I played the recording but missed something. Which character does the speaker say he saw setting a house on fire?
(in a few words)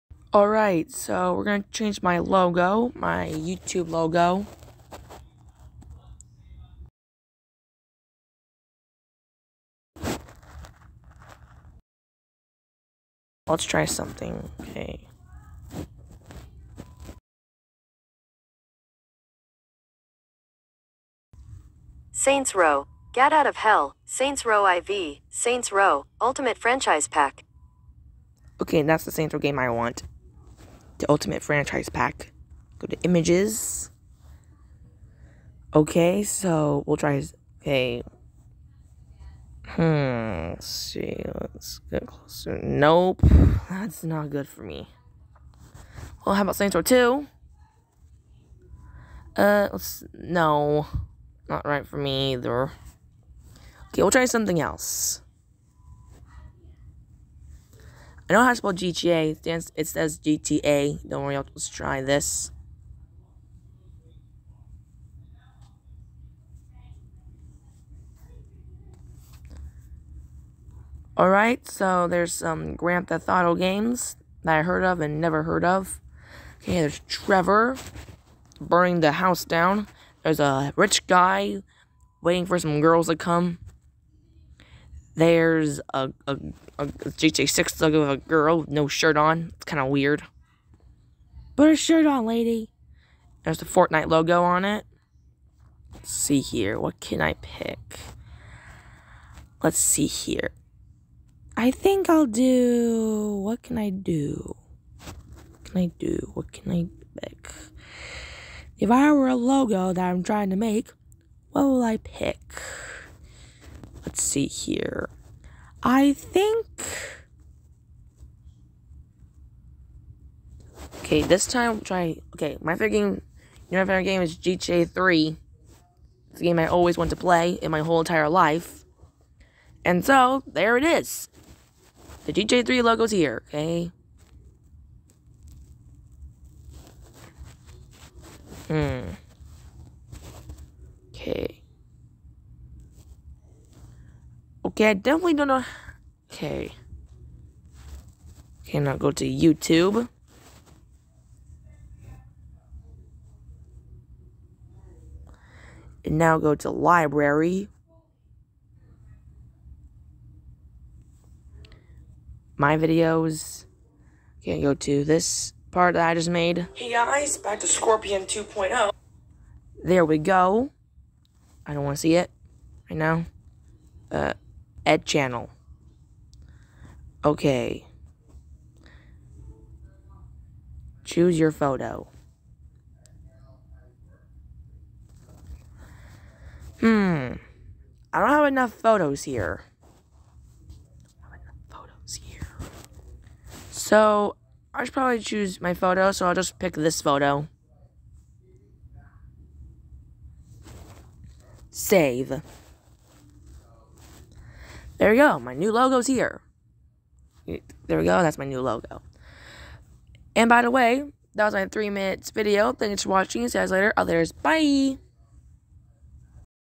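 Trevor.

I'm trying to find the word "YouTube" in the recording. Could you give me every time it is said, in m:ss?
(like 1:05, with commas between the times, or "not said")
0:03, 2:29.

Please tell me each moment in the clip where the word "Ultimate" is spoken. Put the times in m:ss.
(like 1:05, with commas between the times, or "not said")
0:26, 0:31.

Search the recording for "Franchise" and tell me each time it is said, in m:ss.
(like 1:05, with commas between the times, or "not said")
0:26, 0:31.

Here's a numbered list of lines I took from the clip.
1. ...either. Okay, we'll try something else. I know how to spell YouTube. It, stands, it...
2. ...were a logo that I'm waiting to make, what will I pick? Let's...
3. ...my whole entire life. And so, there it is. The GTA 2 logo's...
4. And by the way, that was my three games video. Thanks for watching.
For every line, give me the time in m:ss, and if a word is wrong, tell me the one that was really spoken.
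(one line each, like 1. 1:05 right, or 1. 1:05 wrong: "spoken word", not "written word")
1. 0:52 wrong: "GTA", not "YouTube"
2. 1:49 wrong: "trying", not "waiting"
3. 2:07 wrong: "3", not "2"
4. 3:30 wrong: "minutes", not "games".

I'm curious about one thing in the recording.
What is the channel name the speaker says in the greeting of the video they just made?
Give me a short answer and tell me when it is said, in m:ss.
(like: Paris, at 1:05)
Scorpion 2.0, at 2:47.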